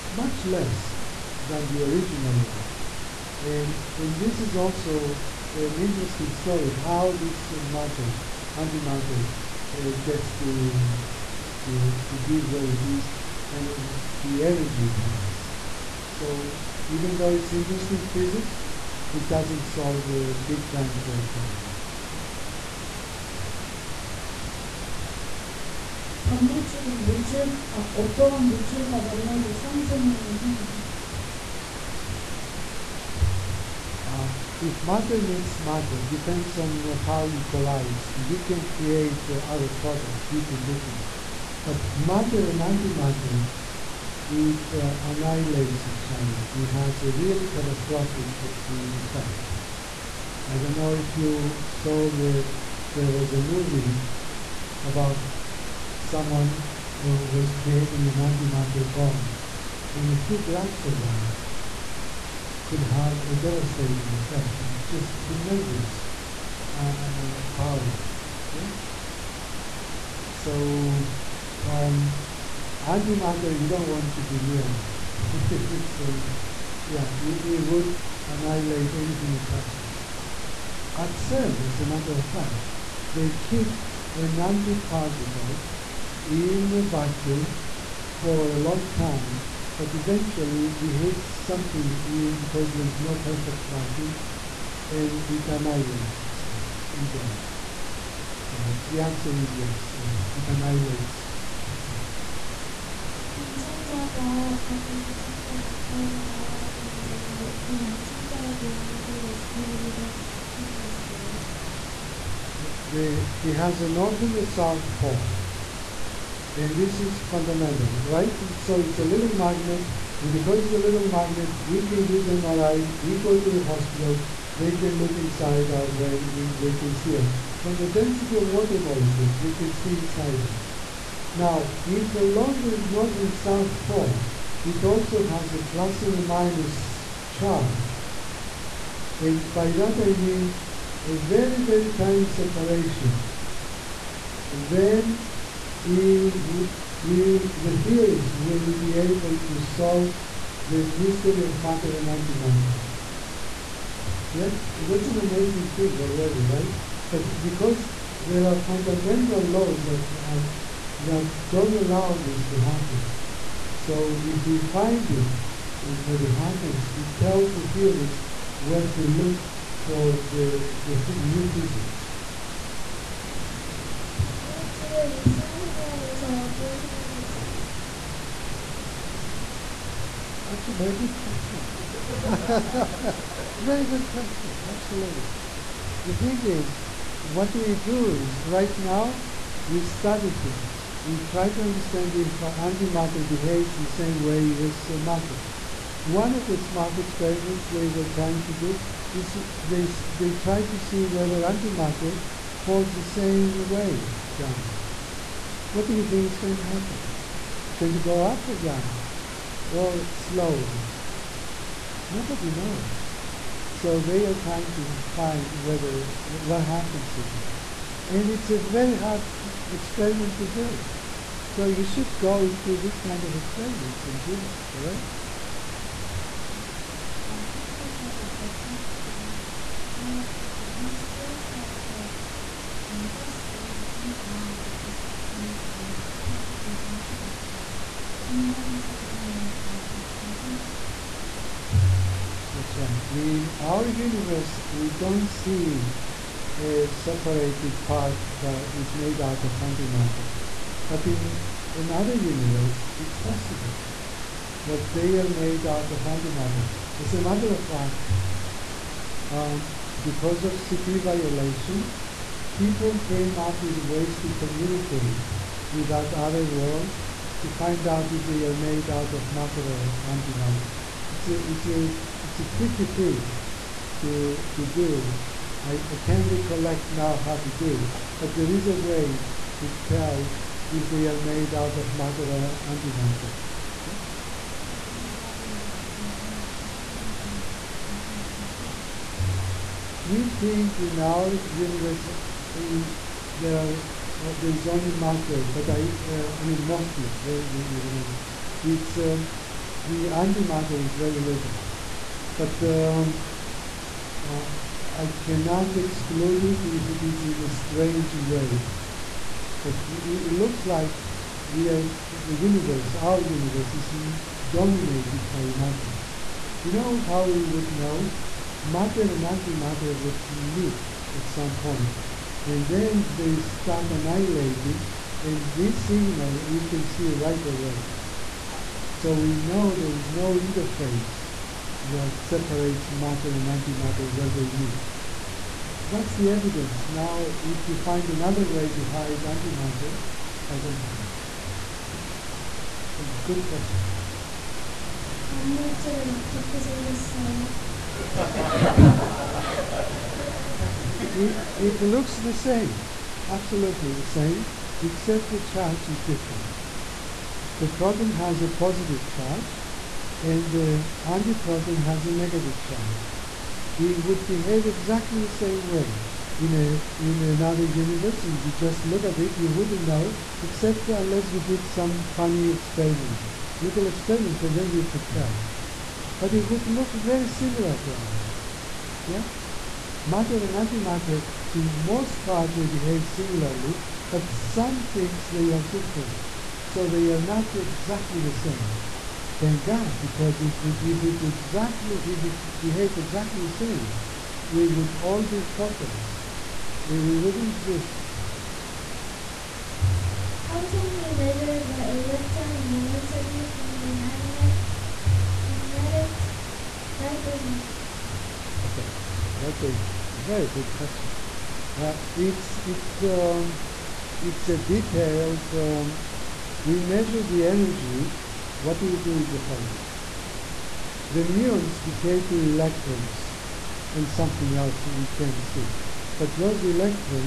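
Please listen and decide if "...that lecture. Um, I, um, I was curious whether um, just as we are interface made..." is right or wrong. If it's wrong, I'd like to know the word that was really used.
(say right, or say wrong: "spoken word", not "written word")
wrong: "existence", not "interface".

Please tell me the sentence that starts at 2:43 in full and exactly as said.
So if we find it, it, eh, that it happens, it tells the theories where to look for the, the new physics.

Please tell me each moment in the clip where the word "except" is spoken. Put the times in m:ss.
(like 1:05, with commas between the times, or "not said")
5:54, 6:10.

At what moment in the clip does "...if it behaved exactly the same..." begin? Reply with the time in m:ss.
6:32.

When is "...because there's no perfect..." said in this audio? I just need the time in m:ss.
1:32.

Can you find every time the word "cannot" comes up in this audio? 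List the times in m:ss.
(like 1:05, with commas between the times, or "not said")
5:05.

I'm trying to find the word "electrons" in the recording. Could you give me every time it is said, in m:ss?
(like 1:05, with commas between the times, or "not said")
6:41, 7:02, 7:06.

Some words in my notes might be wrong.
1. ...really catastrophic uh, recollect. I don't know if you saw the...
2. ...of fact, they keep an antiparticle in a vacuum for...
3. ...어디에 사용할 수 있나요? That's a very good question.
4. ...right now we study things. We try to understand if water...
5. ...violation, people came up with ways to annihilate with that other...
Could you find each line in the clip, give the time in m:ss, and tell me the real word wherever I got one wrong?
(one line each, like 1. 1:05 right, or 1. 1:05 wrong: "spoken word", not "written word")
1. 0:47 wrong: "effect", not "recollect"
2. 1:22 right
3. 2:56 right
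4. 3:08 wrong: "antimatter", not "water"
5. 4:21 wrong: "communicate", not "annihilate".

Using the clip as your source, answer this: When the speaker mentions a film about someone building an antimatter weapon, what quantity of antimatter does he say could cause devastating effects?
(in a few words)
A few grams.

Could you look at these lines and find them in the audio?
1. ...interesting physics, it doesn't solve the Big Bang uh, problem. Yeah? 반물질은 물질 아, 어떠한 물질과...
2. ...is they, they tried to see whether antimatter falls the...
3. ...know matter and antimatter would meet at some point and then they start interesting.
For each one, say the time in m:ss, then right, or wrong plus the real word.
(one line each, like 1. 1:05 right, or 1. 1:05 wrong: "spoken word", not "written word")
1. 0:17 right
2. 3:19 right
3. 5:17 wrong: "annihilating", not "interesting".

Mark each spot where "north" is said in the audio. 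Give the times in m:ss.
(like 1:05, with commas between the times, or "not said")
1:53, 2:12.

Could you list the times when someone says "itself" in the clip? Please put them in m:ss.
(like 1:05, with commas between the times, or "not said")
1:36, 1:41.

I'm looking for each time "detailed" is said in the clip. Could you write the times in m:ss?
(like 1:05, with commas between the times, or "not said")
6:54.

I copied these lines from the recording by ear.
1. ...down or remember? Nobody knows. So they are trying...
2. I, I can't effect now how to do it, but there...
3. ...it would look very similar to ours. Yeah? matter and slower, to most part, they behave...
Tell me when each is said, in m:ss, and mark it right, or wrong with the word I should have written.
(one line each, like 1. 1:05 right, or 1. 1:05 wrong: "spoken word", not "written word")
1. 3:28 wrong: "slower", not "remember"
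2. 4:35 wrong: "recollect", not "effect"
3. 6:16 wrong: "antimatter", not "slower".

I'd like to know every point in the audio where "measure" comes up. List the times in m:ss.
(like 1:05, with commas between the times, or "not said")
6:41, 6:56.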